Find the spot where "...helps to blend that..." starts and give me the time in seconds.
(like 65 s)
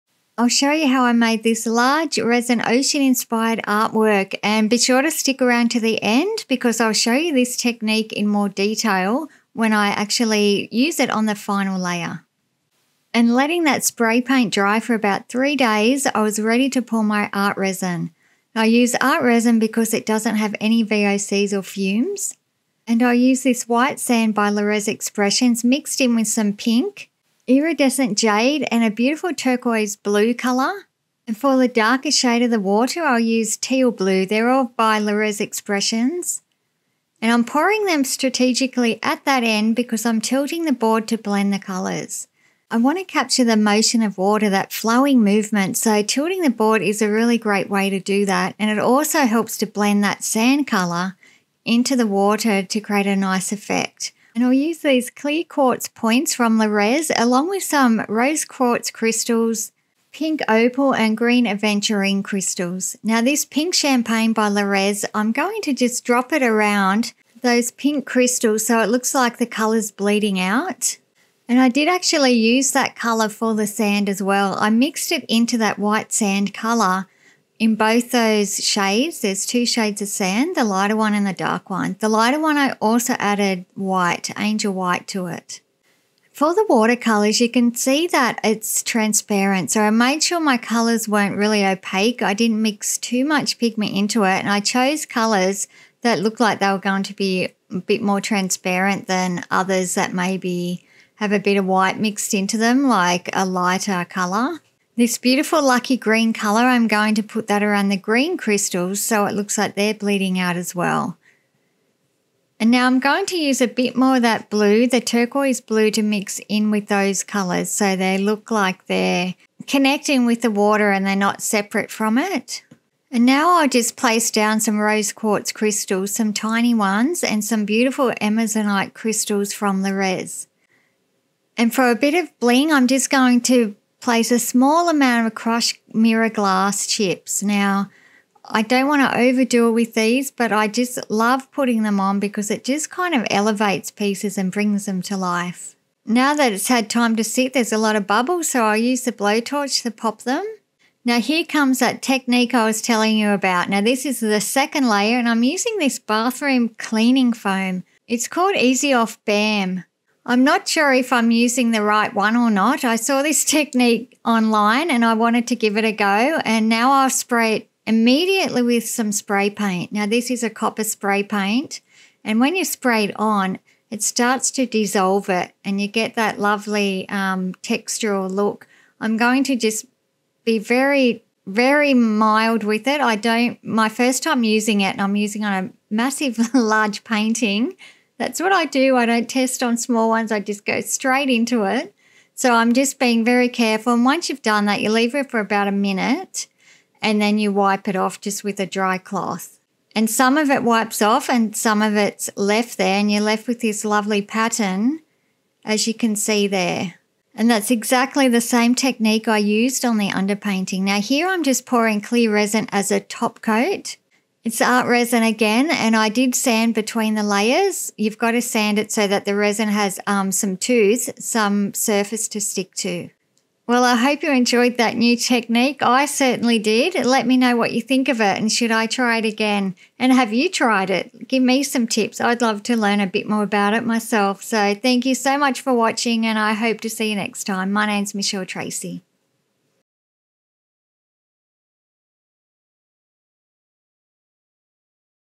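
49 s.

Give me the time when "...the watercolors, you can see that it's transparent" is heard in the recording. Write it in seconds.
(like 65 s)
86 s.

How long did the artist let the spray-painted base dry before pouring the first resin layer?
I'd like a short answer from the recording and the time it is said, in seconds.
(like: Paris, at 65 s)
3 days, at 14 s.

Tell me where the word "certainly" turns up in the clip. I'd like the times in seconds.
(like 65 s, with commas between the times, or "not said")
226 s.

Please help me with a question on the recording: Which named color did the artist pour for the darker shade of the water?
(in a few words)
Teal blue.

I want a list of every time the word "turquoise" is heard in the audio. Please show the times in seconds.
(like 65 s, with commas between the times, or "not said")
29 s, 115 s.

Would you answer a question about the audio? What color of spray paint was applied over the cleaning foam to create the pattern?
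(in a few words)
Copper.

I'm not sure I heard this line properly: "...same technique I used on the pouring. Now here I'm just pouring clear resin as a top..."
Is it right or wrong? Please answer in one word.
wrong.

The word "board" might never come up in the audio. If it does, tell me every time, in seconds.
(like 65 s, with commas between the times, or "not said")
40 s, 46 s.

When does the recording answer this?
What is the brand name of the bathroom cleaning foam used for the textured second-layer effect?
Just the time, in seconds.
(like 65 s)
158 s.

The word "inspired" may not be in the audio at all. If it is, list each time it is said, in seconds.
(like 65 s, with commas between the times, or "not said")
3 s.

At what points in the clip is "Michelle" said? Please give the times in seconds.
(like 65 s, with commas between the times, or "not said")
238 s.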